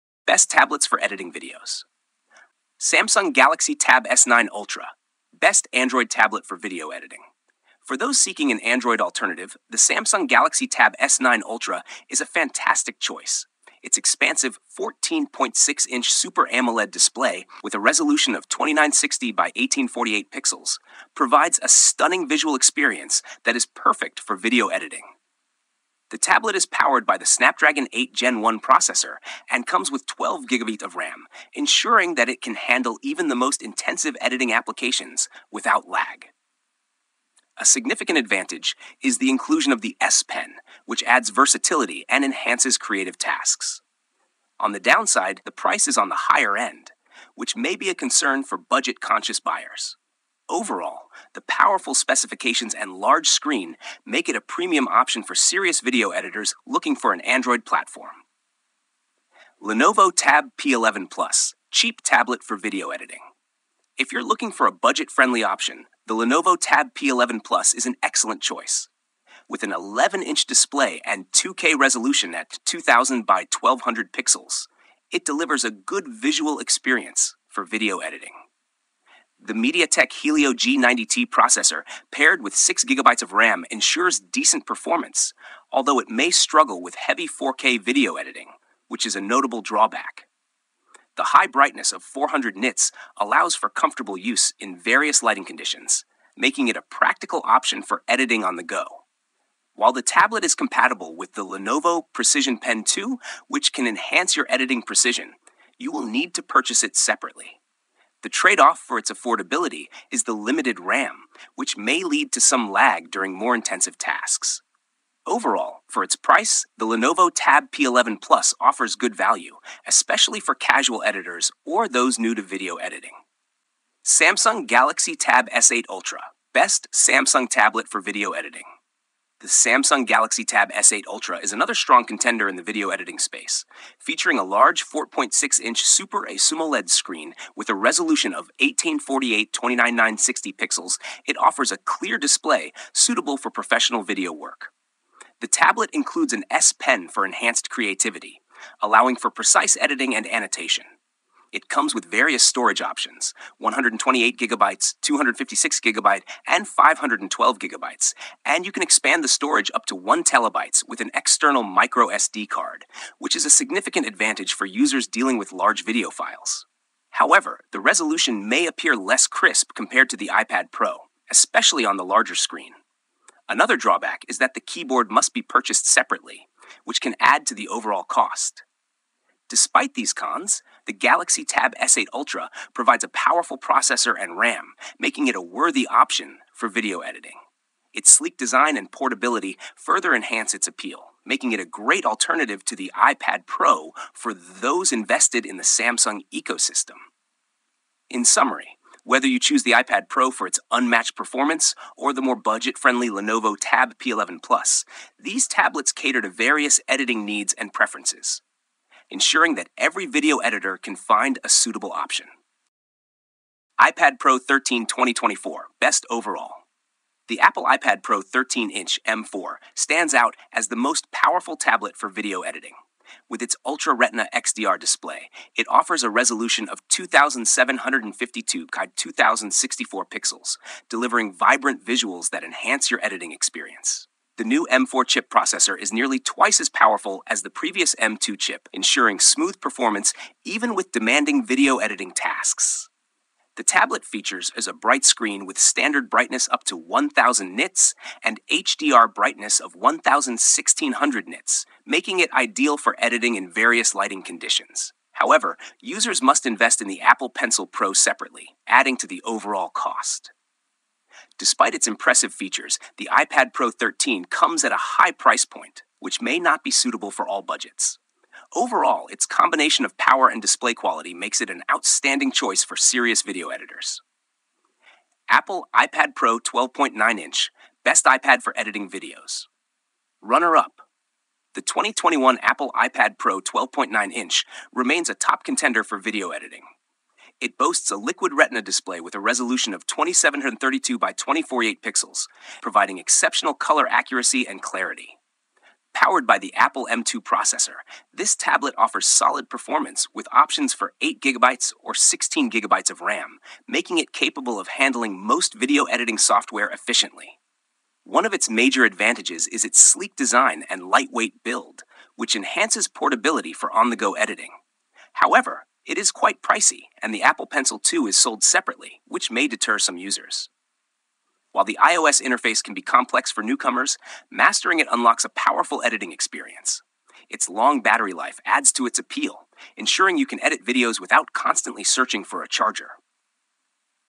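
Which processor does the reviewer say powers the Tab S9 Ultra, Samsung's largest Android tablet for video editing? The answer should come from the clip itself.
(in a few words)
Snapdragon 8 Gen 1.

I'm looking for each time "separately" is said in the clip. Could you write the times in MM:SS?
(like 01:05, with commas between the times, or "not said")
01:46, 02:55, 04:17, 05:18.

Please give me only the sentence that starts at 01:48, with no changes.
The trade off for its affordability is the limited RAM, which may lead to some lag during more intensive tasks.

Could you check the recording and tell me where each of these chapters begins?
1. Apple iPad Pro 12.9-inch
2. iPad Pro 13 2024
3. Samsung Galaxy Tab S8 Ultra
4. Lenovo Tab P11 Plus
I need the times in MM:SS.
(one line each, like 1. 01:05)
1. 04:36
2. 03:36
3. 02:08
4. 00:59.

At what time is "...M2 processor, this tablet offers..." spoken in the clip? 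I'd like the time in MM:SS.
04:56.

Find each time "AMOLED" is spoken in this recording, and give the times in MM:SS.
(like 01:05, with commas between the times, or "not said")
00:16.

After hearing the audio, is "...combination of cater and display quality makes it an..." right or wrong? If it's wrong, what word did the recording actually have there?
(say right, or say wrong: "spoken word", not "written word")
wrong: "power", not "cater".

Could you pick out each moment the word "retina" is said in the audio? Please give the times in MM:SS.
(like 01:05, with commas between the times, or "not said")
03:43, 04:48.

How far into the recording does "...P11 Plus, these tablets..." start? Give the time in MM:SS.
03:23.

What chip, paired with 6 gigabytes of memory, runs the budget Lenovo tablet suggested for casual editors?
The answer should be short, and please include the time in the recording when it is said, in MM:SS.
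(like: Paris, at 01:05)
MediaTek Helio G90T, at 01:19.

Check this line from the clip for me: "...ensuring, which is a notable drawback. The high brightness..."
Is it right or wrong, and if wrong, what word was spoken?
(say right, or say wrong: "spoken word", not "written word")
wrong: "editing", not "ensuring".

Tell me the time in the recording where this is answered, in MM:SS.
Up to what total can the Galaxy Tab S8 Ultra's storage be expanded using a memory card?
02:39.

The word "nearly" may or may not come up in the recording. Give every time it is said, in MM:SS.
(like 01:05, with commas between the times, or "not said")
03:55.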